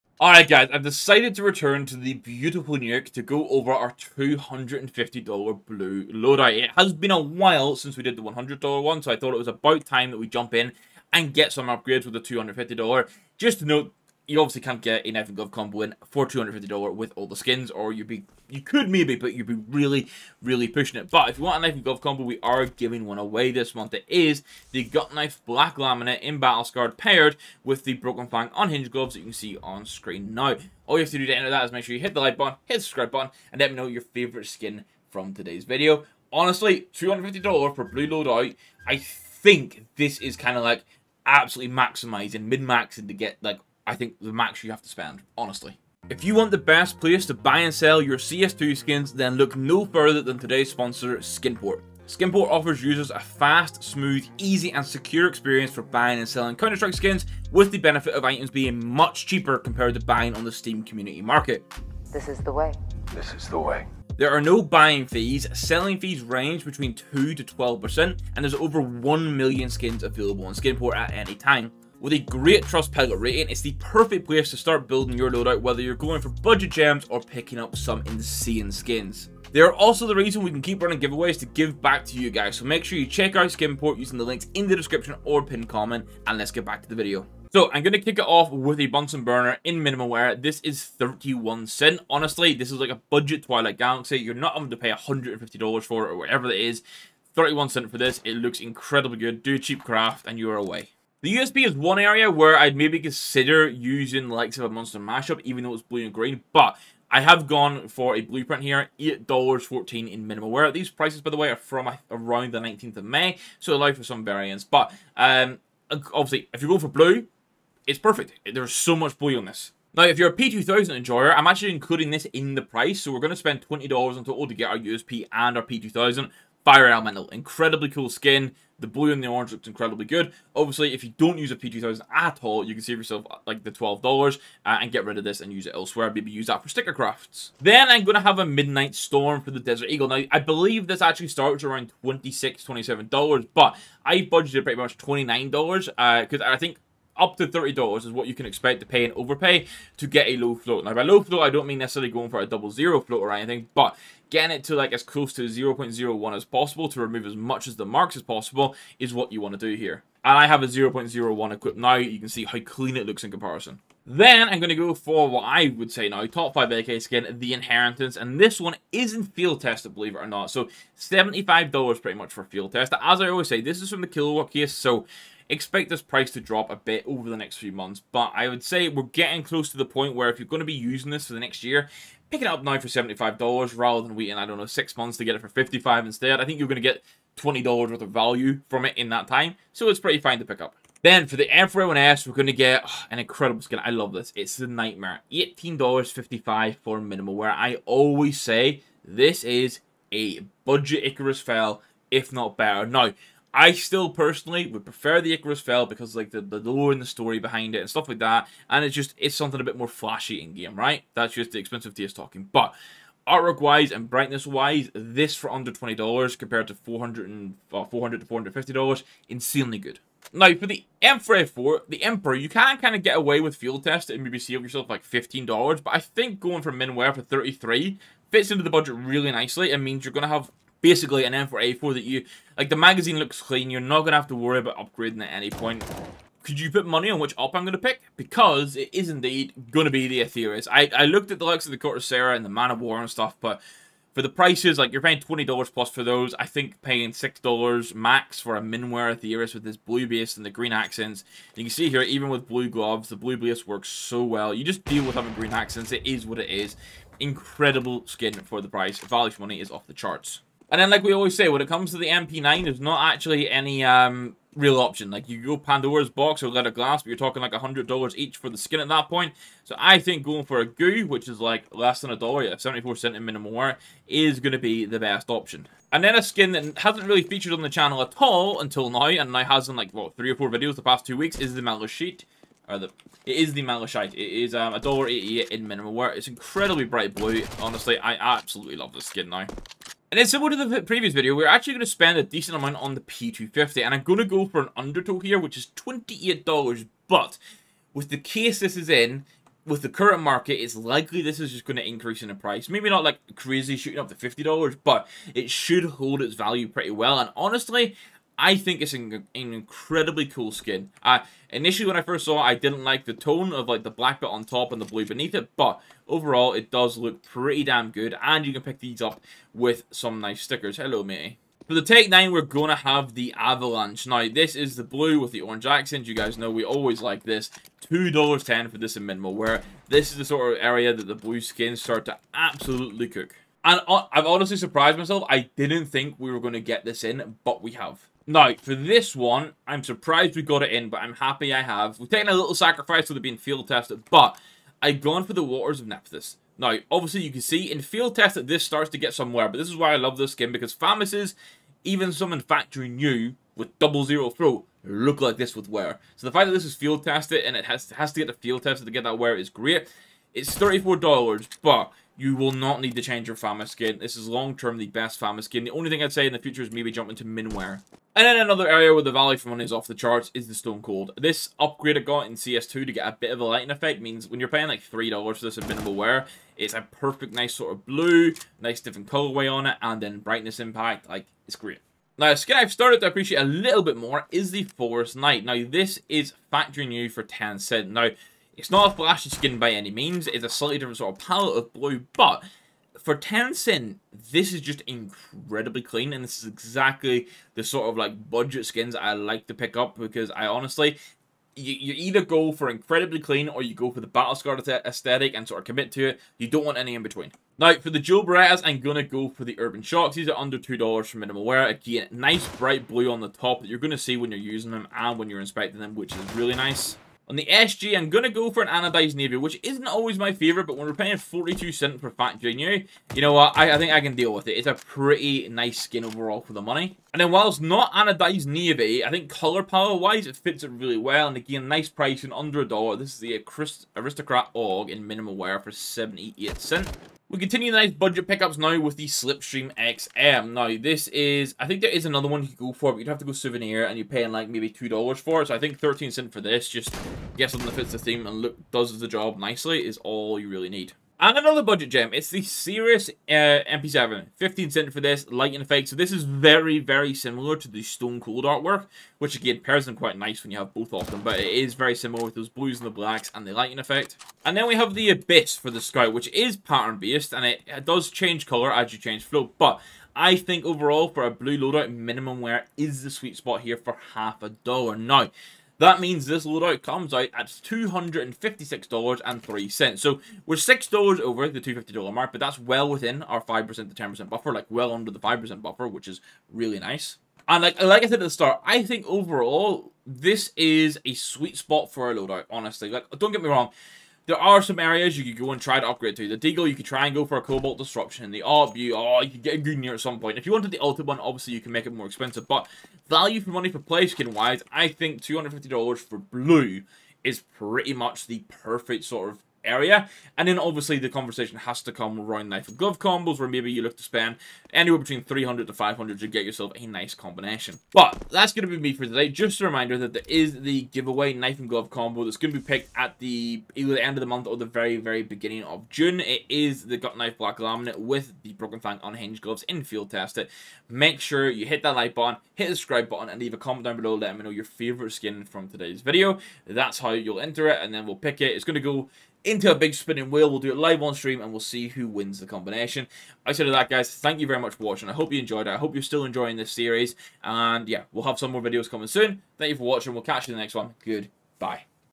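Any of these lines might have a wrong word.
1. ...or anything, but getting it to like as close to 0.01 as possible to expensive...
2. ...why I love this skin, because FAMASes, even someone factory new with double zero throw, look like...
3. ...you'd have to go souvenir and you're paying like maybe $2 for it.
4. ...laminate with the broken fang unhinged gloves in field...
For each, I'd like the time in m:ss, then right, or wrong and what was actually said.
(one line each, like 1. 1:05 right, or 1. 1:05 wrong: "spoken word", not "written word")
1. 2:33 wrong: "remove", not "expensive"
2. 5:49 right
3. 7:22 right
4. 8:47 right.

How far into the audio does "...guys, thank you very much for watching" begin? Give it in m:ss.
9:03.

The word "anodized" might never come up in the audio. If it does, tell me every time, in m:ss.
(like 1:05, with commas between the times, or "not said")
6:58, 7:07.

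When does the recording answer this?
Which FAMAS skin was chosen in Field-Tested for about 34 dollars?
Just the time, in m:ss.
5:45.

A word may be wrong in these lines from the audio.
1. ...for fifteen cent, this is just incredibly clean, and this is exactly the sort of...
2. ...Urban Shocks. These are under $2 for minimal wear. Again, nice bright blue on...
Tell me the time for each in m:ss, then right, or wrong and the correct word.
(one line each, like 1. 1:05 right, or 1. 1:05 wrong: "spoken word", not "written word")
1. 6:32 wrong: "ten", not "fifteen"
2. 6:49 right.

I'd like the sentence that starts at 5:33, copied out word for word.
And uh, I've honestly surprised myself.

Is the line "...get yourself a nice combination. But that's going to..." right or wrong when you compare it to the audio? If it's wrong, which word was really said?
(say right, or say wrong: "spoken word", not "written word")
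right.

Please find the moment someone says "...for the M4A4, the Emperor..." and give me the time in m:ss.
3:40.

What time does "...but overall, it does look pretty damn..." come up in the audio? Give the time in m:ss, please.
5:15.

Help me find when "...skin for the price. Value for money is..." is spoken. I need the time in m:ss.
4:18.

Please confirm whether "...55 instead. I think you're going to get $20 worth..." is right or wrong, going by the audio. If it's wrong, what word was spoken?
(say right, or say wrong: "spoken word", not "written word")
right.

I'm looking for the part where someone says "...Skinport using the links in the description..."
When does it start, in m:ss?
1:23.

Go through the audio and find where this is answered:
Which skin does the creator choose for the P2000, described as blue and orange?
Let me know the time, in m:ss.
2:06.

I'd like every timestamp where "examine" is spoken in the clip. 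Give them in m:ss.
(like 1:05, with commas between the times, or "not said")
not said.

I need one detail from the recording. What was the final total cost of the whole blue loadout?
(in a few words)
$256.03.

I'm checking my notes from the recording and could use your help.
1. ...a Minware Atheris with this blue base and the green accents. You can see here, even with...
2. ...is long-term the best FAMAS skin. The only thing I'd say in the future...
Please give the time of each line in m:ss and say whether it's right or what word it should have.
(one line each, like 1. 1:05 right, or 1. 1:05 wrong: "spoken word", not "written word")
1. 4:08 right
2. 6:04 right.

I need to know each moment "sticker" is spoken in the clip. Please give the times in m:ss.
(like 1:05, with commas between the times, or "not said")
2:16, 5:20.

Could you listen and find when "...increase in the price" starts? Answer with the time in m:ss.
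5:01.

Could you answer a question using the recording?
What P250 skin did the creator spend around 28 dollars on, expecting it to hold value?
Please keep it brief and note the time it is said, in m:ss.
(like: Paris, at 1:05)
Undertow, at 4:54.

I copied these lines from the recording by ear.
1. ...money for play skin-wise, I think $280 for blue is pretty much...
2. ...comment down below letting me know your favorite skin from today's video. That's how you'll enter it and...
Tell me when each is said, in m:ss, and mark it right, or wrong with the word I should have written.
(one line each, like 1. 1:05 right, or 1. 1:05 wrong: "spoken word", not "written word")
1. 8:23 wrong: "250", not "280"
2. 8:53 right.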